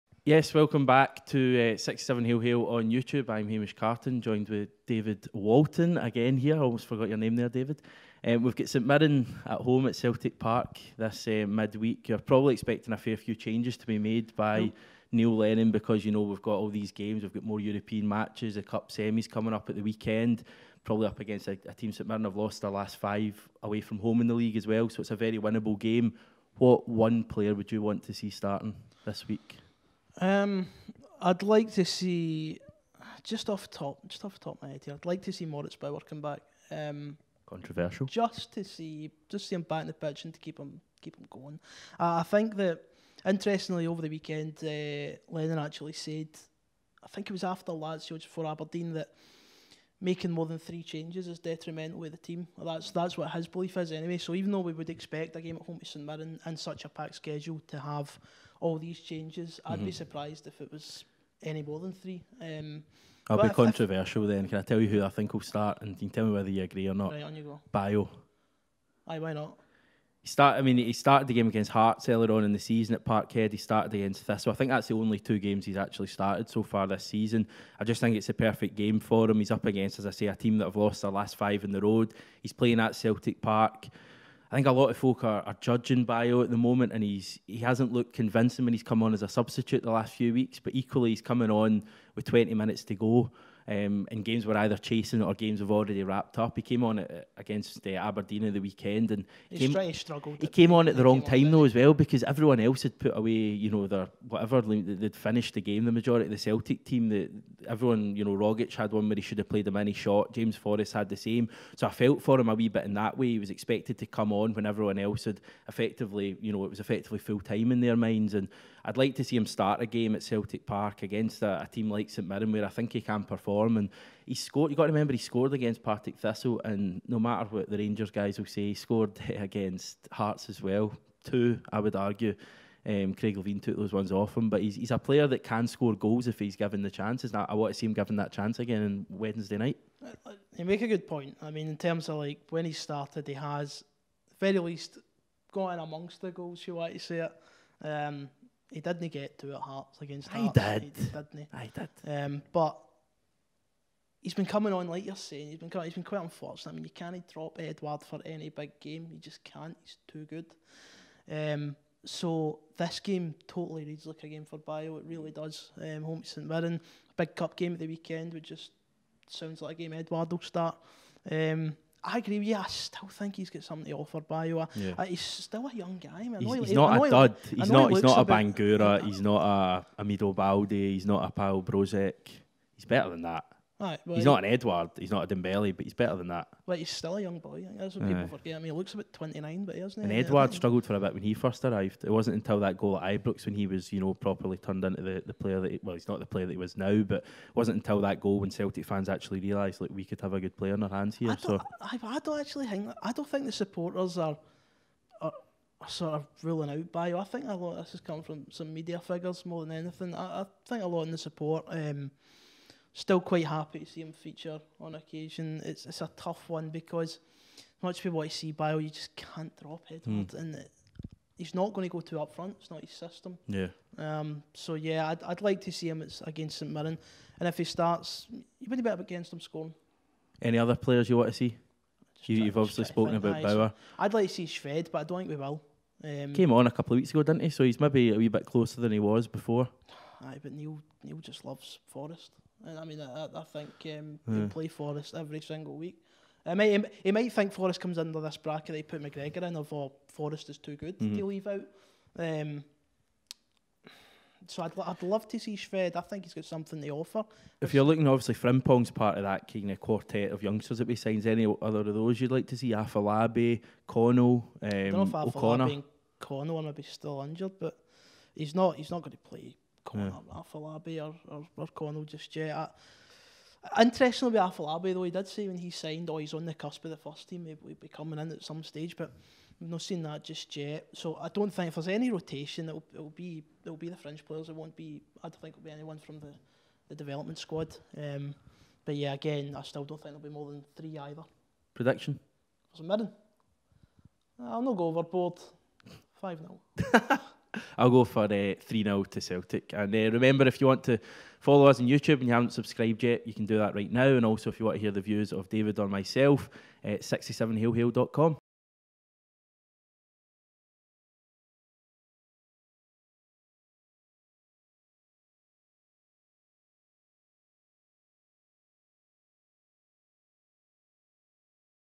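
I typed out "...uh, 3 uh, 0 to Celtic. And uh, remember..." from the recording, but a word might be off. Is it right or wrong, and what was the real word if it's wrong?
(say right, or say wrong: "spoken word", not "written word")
right.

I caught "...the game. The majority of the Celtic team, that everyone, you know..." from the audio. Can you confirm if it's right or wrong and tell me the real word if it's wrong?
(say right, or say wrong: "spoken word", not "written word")
right.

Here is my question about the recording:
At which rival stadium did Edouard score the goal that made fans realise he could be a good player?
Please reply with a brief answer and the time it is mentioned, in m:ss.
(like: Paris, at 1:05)
Ibrox, at 3:13.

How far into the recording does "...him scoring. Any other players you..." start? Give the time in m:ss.
3:49.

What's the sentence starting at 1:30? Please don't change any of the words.
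But equally, he's coming on with 20 minutes to go um, in games we're either chasing or games we've already wrapped up.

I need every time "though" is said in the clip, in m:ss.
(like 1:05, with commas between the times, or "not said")
0:54, 1:41, 4:34.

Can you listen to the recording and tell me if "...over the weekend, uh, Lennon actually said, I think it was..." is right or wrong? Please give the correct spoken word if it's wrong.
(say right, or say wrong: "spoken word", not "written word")
right.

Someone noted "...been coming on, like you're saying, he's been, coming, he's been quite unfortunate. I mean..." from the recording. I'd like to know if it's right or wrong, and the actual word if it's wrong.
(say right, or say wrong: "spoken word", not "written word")
right.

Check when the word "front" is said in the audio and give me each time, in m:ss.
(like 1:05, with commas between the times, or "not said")
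3:42.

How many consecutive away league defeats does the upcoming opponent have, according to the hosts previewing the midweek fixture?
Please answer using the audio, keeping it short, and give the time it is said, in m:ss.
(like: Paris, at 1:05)
5, at 0:22.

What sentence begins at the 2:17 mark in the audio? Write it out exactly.
I, I want to see him given that chance again on Wednesday night.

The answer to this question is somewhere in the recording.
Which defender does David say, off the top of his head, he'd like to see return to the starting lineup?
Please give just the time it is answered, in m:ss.
0:35.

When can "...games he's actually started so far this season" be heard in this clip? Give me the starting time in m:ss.
1:15.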